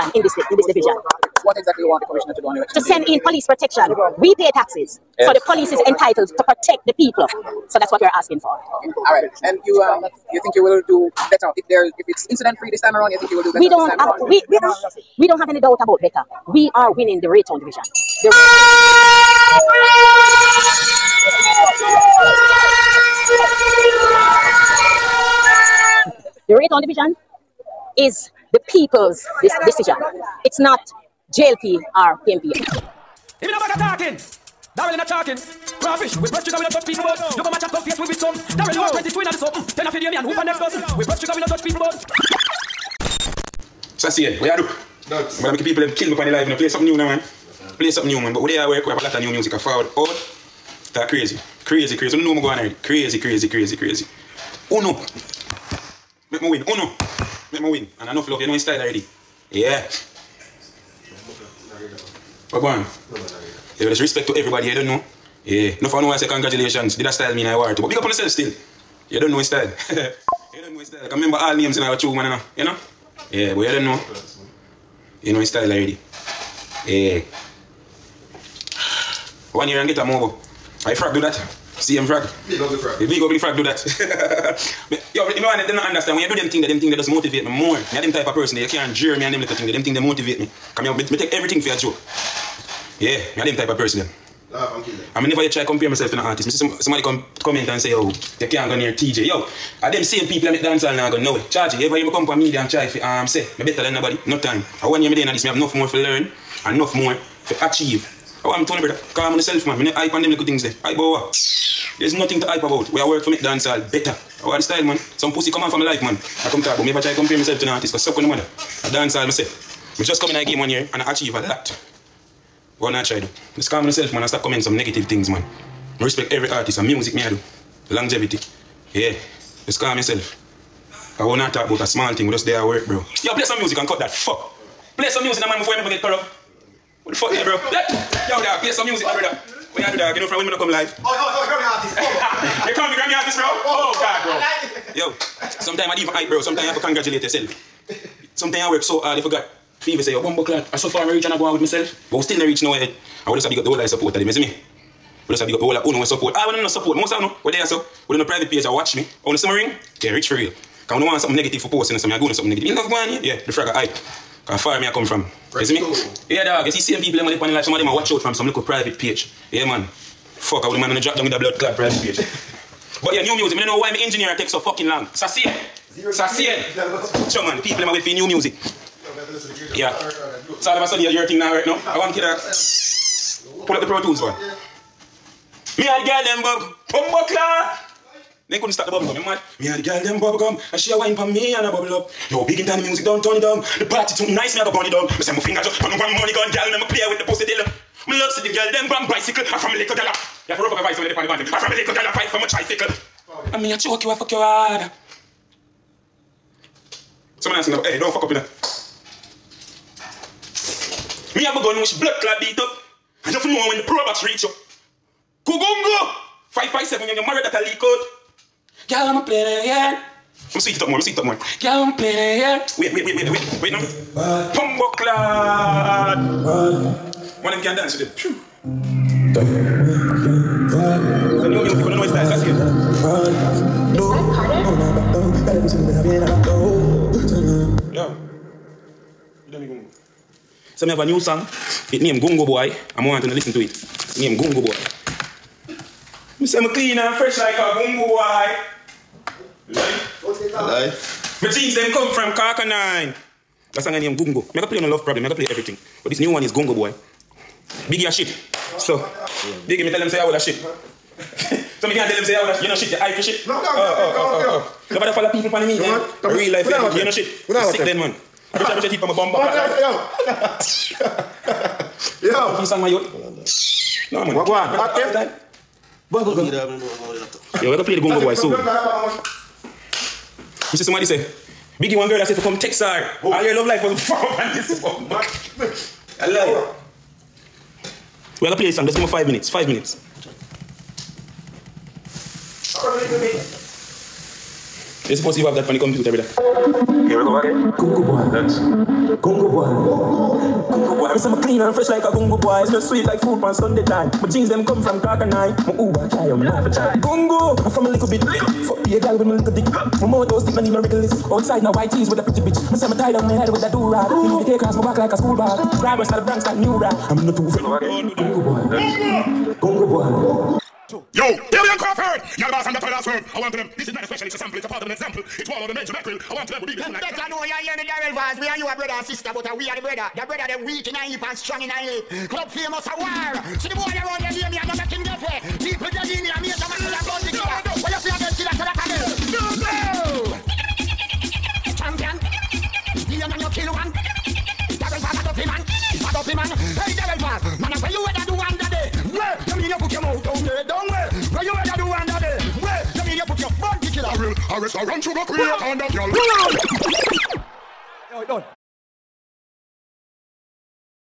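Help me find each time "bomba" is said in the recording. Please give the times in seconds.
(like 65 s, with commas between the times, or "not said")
269 s.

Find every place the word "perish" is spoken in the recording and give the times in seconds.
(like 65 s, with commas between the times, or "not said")
not said.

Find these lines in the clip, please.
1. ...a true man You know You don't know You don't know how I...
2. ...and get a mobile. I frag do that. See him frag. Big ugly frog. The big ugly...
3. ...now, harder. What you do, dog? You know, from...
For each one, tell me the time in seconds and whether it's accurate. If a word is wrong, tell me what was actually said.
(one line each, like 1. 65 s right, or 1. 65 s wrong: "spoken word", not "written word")
1. 71 s right
2. 79 s right
3. 139 s wrong: "brother", not "harder".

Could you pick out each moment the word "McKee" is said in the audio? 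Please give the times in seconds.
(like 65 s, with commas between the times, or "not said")
not said.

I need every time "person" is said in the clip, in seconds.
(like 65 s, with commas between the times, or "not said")
88 s, 93 s.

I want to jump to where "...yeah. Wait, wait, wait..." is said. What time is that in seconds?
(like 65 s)
222 s.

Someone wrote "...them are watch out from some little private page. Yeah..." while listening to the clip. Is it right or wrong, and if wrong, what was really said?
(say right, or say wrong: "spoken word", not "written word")
right.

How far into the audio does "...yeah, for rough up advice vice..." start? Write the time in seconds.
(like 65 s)
200 s.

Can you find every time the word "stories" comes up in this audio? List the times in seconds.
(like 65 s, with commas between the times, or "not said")
not said.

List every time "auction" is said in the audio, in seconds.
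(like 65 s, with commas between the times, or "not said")
not said.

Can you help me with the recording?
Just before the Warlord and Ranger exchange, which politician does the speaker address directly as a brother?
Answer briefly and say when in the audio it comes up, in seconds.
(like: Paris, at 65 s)
Daryl Vaz, at 327 s.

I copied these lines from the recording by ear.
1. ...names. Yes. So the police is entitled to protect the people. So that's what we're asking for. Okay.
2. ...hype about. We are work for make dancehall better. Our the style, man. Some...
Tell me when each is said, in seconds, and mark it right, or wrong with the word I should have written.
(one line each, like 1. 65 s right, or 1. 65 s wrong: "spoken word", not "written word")
1. 4 s wrong: "taxes", not "names"
2. 112 s right.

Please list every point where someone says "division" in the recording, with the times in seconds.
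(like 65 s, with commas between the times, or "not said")
0 s, 17 s, 26 s.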